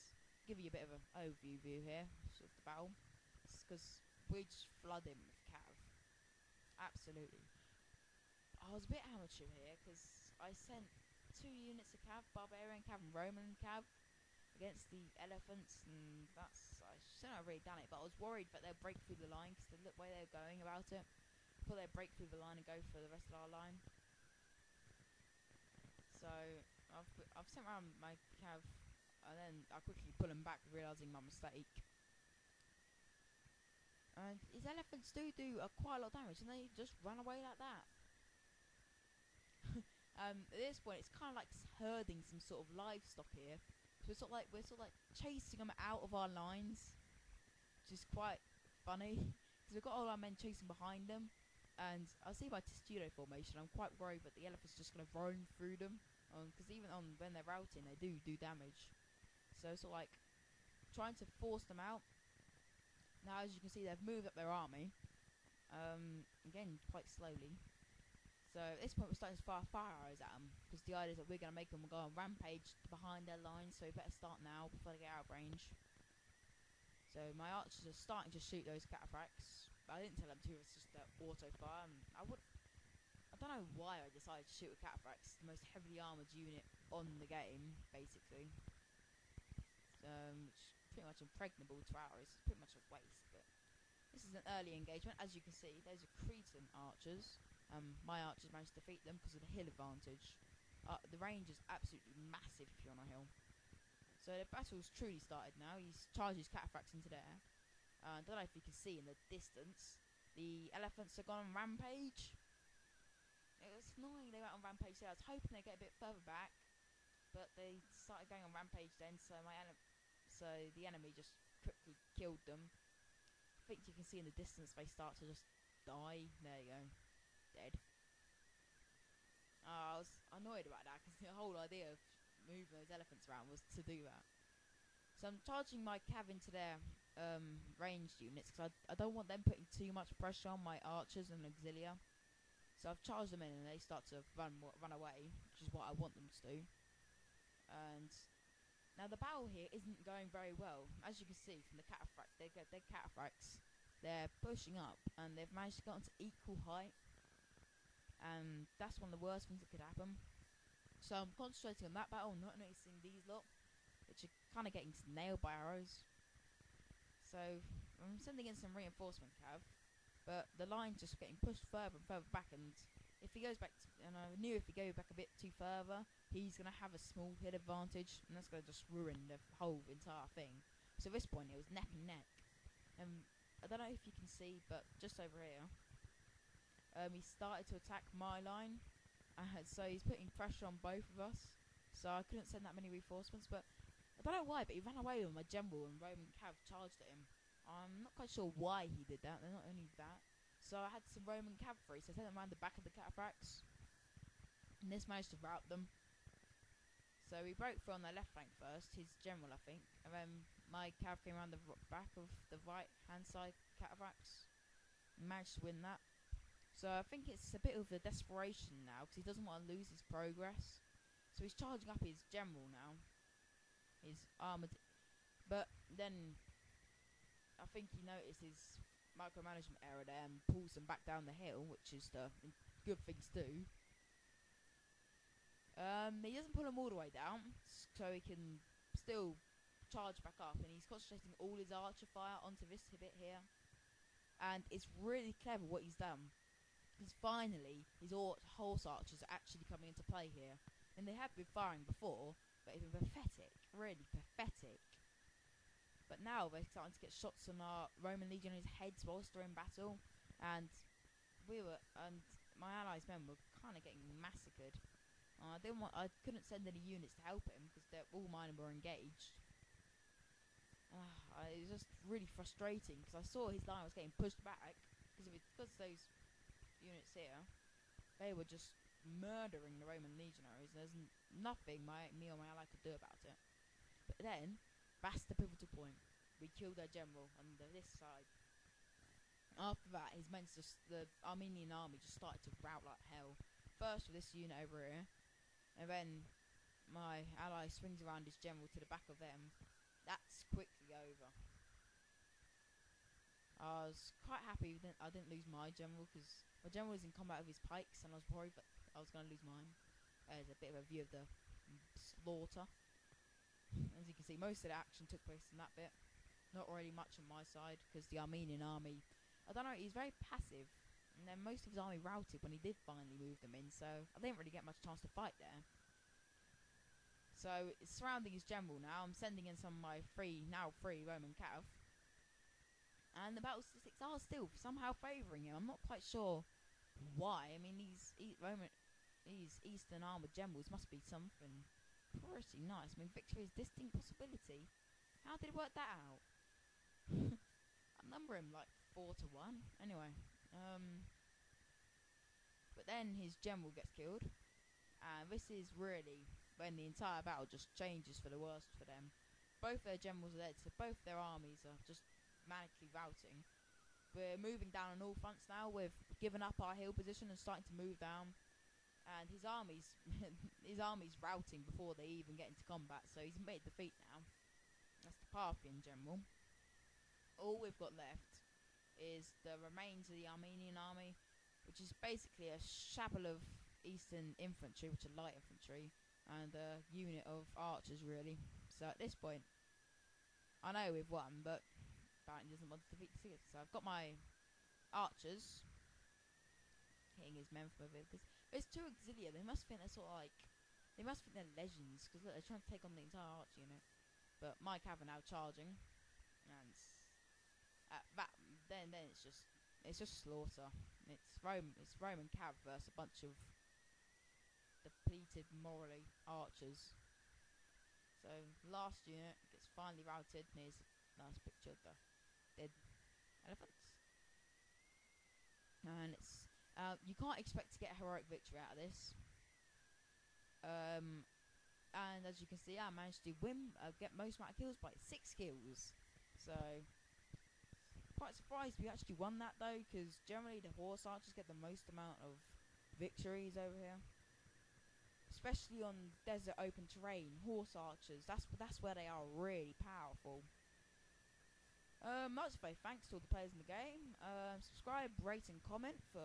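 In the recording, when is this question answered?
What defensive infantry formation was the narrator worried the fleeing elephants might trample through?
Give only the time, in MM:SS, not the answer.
00:52.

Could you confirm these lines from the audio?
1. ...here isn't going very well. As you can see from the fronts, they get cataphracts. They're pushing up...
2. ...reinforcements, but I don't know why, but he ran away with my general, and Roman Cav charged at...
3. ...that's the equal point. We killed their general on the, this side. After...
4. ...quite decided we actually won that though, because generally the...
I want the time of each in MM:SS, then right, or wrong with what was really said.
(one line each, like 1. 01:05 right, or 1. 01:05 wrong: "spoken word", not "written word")
1. 02:29 wrong: "cataphracts", not "fronts"
2. 03:12 right
3. 04:45 wrong: "pivotal", not "equal"
4. 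07:18 wrong: "surprised", not "decided".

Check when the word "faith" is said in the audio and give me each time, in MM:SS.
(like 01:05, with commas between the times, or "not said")
07:32.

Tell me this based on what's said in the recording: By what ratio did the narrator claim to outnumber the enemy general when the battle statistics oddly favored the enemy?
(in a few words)
4 to 1.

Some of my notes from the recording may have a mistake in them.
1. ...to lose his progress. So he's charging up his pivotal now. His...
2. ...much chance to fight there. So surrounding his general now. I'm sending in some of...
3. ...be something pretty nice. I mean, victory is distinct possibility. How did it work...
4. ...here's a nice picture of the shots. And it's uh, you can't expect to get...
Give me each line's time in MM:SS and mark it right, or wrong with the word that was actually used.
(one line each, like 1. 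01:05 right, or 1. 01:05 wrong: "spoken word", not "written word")
1. 03:39 wrong: "general", not "pivotal"
2. 05:24 right
3. 05:40 right
4. 07:00 wrong: "elephants", not "shots".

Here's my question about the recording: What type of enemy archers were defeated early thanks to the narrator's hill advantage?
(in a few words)
Cretan archers.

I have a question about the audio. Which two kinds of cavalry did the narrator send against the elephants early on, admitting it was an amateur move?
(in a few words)
Barbarian cav and Roman cav.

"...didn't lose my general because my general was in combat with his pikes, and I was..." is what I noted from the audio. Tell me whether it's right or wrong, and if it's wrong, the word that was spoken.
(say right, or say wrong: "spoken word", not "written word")
right.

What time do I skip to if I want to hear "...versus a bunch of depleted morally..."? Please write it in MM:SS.
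06:52.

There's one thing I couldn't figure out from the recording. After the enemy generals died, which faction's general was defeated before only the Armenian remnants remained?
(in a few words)
Parthian.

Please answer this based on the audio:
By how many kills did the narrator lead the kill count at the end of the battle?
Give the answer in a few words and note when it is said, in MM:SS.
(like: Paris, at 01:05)
6, at 07:14.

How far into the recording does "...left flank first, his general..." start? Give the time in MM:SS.
03:28.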